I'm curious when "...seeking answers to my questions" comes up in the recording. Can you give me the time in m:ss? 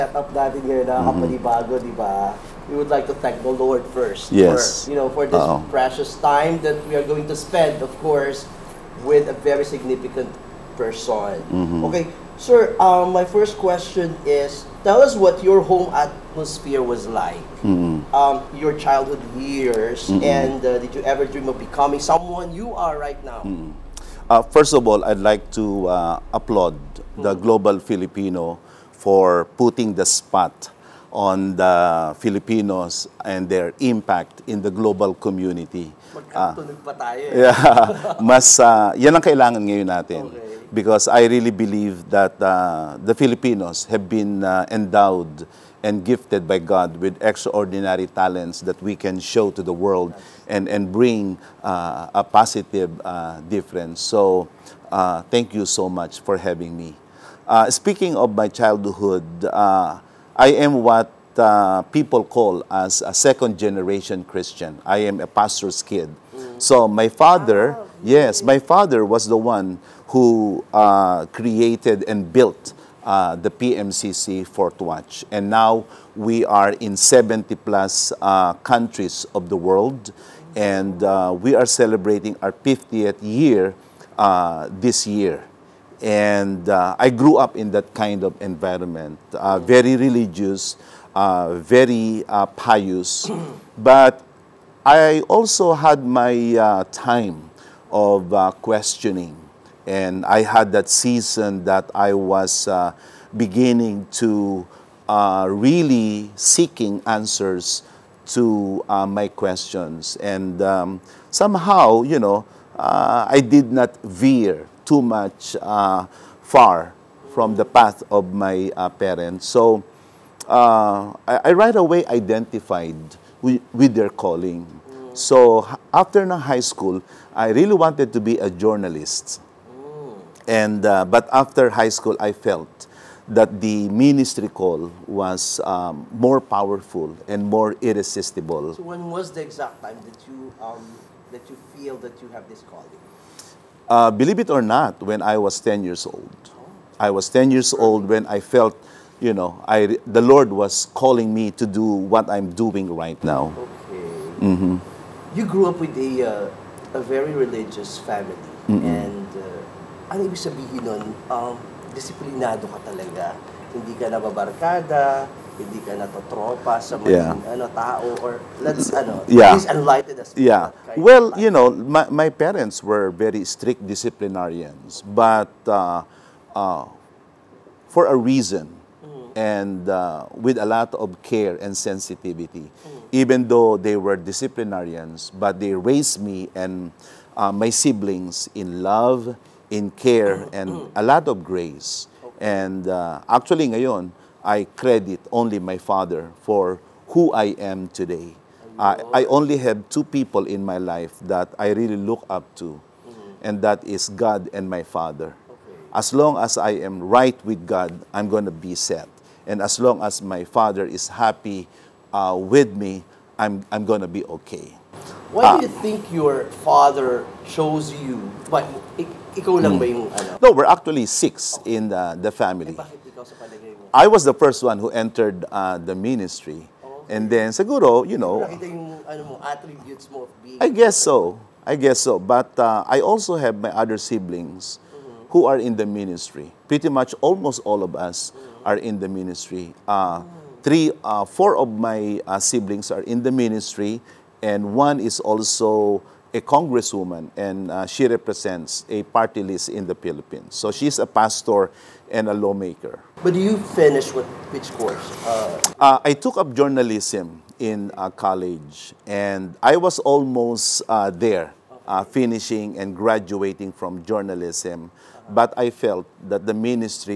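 1:46.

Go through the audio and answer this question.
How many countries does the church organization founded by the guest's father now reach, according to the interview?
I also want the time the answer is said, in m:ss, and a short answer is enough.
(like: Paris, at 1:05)
70 plus, at 1:16.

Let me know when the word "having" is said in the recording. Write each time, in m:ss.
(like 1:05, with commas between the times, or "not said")
0:56.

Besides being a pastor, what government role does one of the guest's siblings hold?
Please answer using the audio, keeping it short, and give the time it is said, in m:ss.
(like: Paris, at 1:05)
congresswoman, at 4:06.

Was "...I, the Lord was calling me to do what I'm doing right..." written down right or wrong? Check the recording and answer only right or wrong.
right.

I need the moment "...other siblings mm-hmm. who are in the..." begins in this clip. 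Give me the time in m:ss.
3:53.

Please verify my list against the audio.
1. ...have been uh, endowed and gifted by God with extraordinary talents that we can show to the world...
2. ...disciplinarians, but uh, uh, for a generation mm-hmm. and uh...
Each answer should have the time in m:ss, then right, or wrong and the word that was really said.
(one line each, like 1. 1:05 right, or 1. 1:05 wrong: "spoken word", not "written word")
1. 0:43 right
2. 2:53 wrong: "reason", not "generation".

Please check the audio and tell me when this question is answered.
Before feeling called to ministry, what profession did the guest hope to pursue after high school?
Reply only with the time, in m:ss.
2:08.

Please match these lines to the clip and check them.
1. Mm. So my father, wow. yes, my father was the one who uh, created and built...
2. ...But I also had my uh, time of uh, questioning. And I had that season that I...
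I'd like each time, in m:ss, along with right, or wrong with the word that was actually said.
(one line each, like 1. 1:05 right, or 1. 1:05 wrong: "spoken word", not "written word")
1. 1:06 right
2. 1:33 right.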